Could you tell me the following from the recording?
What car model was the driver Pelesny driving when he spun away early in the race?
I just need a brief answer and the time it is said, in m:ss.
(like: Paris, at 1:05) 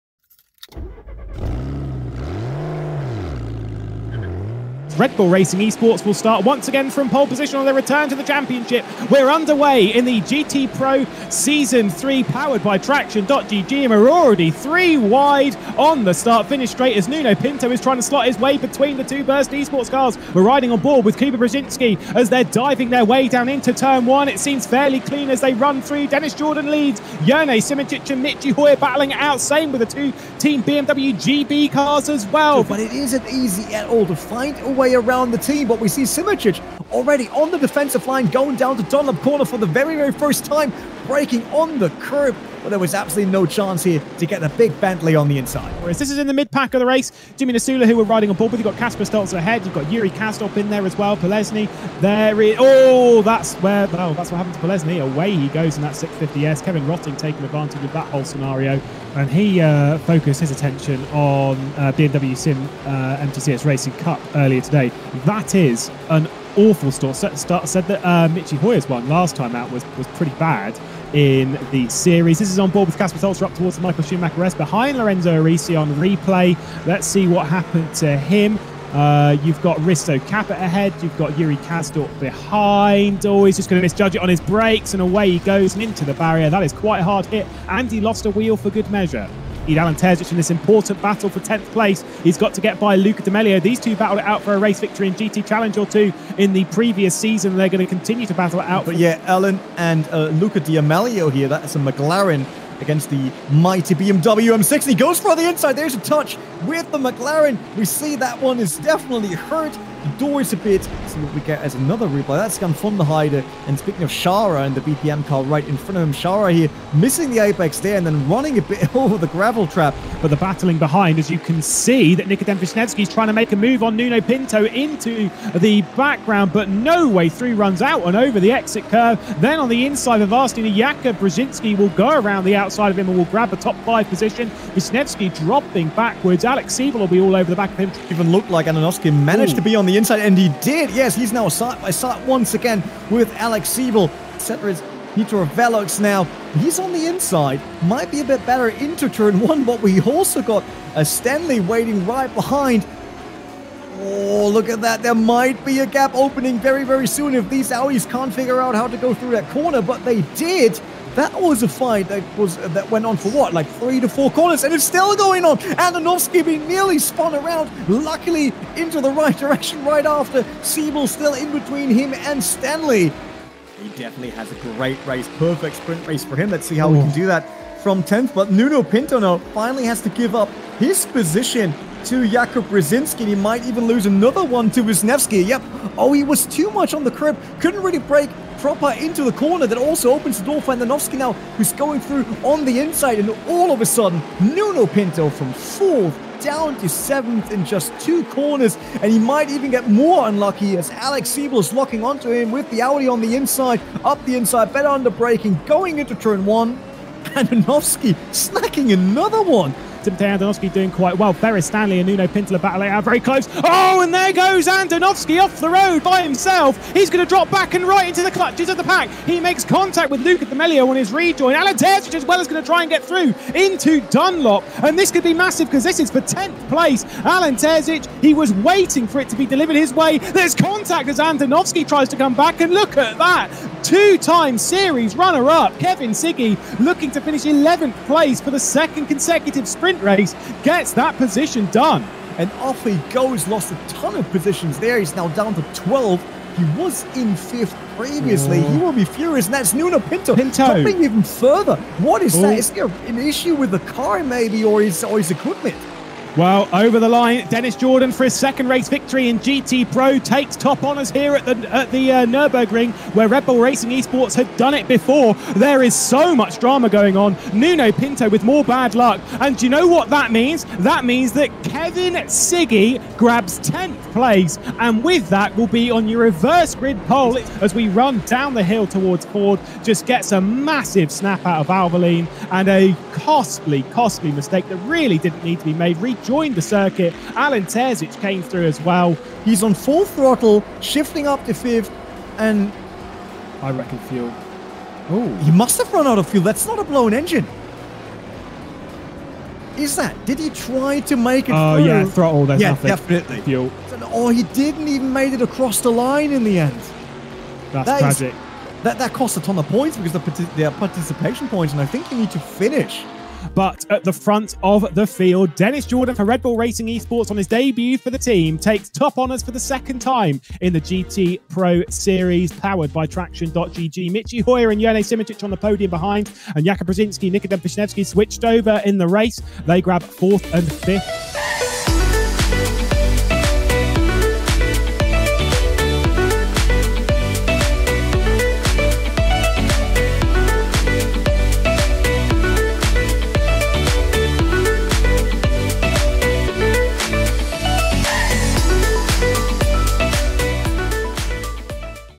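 650S, at 0:55.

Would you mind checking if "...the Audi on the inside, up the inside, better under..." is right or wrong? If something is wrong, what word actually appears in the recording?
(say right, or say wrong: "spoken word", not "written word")
right.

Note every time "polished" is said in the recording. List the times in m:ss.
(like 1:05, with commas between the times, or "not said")
not said.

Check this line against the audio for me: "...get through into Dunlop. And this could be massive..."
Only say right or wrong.
right.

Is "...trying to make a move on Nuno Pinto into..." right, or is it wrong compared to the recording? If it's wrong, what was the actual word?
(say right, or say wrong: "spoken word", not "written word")
right.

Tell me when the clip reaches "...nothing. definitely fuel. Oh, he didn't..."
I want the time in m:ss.
5:02.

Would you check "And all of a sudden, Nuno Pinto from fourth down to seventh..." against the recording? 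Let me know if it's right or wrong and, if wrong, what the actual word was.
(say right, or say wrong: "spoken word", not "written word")
right.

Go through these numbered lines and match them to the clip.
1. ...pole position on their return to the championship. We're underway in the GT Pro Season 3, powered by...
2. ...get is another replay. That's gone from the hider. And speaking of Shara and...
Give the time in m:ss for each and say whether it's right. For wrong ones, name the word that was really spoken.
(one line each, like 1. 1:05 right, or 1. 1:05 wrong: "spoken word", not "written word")
1. 0:07 right
2. 1:51 right.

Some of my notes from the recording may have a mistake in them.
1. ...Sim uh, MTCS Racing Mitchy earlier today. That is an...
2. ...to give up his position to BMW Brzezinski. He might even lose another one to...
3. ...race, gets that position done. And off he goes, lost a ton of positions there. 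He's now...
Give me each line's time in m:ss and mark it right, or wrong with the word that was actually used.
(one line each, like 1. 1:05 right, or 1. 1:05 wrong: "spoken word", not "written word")
1. 1:02 wrong: "Cup", not "Mitchy"
2. 3:00 wrong: "Jakub", not "BMW"
3. 4:00 right.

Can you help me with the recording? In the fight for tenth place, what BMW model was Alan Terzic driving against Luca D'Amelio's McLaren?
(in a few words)
BMW M6.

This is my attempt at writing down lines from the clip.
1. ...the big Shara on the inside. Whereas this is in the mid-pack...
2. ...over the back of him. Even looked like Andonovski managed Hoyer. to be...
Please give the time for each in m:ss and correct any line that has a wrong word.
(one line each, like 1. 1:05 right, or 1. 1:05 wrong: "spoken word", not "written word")
1. 0:44 wrong: "Bentley", not "Shara"
2. 2:17 wrong: "Ooh", not "Hoyer".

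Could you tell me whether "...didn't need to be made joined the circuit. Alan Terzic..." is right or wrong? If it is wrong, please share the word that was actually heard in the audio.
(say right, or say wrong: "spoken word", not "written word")
right.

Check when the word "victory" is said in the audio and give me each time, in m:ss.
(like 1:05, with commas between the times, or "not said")
1:34, 4:18.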